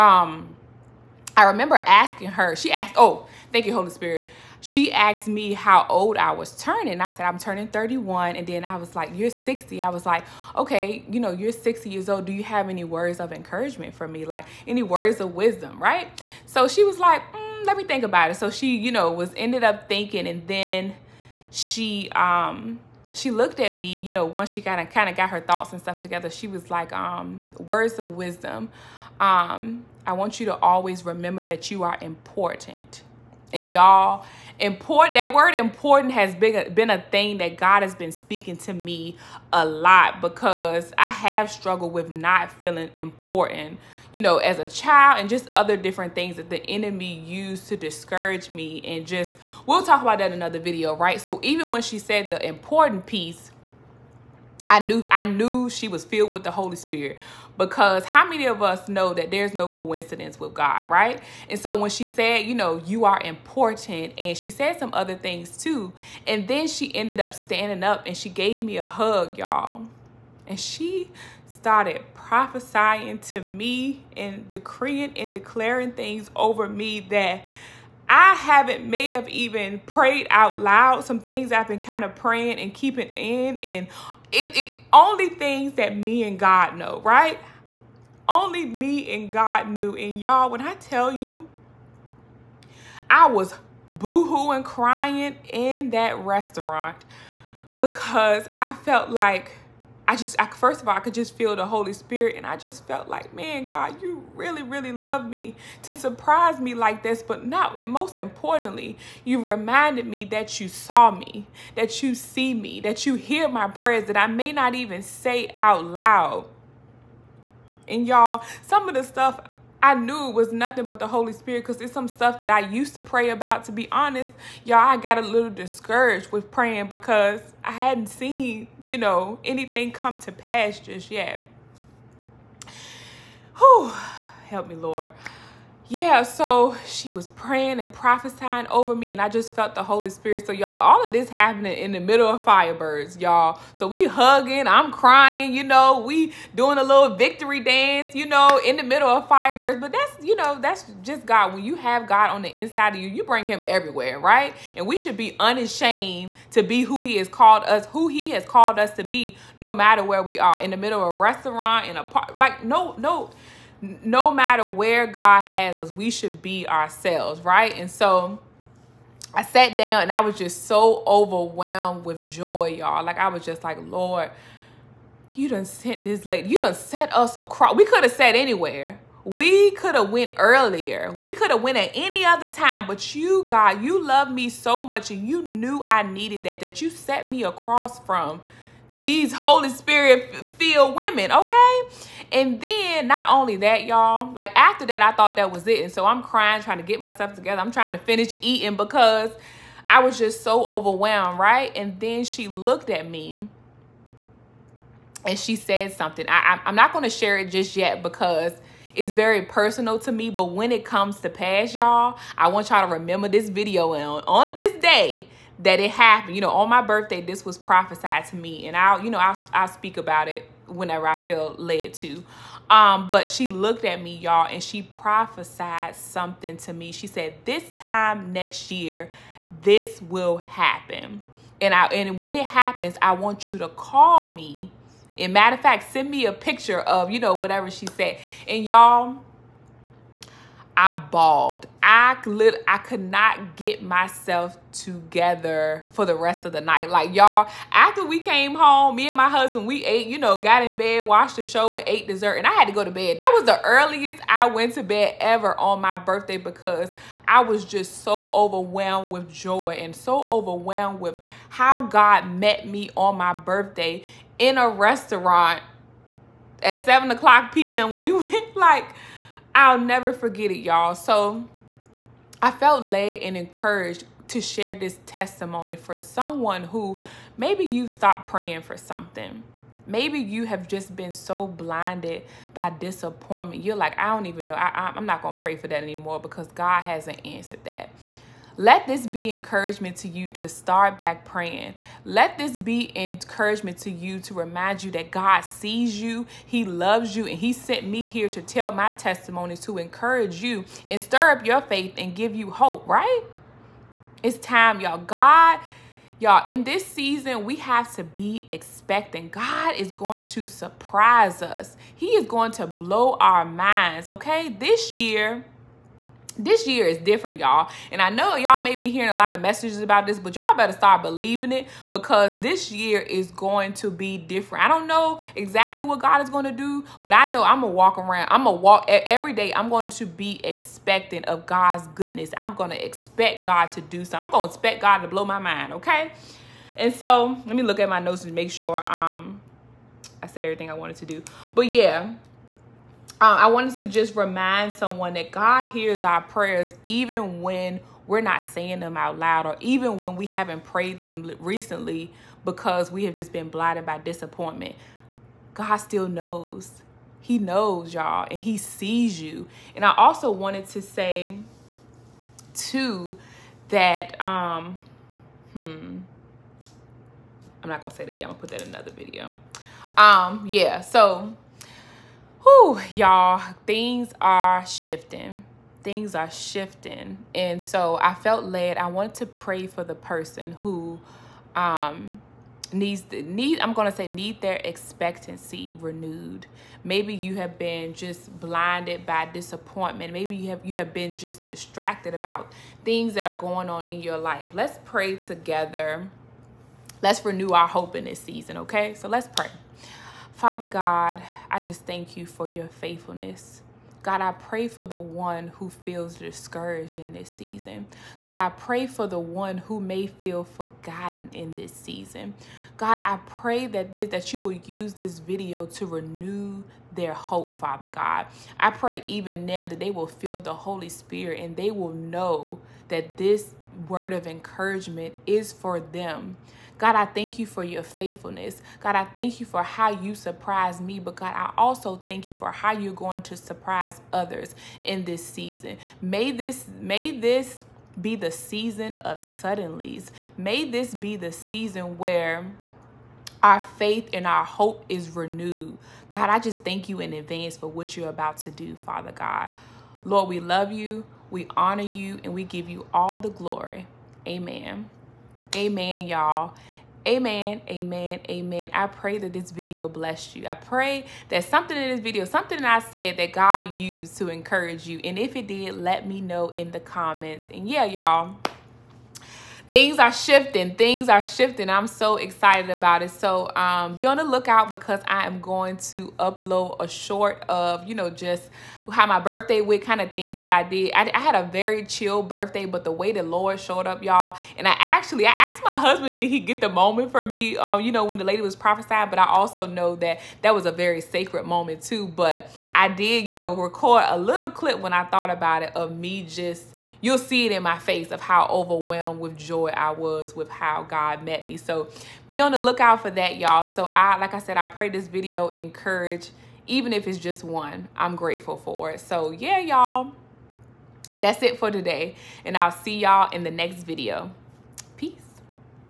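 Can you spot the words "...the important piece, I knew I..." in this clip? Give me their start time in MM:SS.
00:52.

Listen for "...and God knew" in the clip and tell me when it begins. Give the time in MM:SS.
01:29.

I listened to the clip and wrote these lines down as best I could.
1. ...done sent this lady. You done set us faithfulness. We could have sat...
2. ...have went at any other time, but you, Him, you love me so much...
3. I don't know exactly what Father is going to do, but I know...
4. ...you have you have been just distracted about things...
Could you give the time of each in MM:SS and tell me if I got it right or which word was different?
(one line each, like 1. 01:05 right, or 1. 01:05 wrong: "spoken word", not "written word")
1. 02:55 wrong: "across", not "faithfulness"
2. 03:01 wrong: "God", not "Him"
3. 05:24 wrong: "God", not "Father"
4. 06:30 right.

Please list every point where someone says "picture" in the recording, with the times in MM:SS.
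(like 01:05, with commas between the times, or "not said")
03:56.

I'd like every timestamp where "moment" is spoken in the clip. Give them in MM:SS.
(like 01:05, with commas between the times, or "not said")
08:06, 08:11.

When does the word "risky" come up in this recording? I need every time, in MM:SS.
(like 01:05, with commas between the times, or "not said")
not said.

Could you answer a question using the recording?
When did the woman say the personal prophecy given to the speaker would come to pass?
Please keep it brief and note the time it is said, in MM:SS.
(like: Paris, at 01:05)
This time next year, at 03:47.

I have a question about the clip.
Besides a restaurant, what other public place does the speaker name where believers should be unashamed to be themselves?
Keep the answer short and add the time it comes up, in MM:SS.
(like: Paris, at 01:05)
a park, at 02:41.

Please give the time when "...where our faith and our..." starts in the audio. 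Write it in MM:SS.
07:21.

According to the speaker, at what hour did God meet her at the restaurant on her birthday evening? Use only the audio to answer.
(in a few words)
7 p.m.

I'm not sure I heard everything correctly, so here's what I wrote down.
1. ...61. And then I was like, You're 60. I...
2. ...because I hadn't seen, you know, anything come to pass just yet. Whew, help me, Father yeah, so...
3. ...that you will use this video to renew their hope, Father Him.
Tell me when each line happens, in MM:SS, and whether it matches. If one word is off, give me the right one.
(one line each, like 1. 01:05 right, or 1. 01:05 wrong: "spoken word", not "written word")
1. 00:07 wrong: "31", not "61"
2. 02:06 wrong: "Lord", not "Father"
3. 06:54 wrong: "God", not "Him".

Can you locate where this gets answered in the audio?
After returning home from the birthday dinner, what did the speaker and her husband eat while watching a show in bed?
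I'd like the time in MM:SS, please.
04:12.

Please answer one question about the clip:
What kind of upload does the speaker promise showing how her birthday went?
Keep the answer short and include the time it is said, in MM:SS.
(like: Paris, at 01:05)
a short, at 07:56.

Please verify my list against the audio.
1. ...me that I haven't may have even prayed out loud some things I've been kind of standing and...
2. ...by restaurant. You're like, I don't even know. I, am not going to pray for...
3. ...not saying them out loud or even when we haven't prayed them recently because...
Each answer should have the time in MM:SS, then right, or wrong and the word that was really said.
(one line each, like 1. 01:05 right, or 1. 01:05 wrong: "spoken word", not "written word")
1. 01:16 wrong: "praying", not "standing"
2. 04:42 wrong: "disappointment", not "restaurant"
3. 05:48 right.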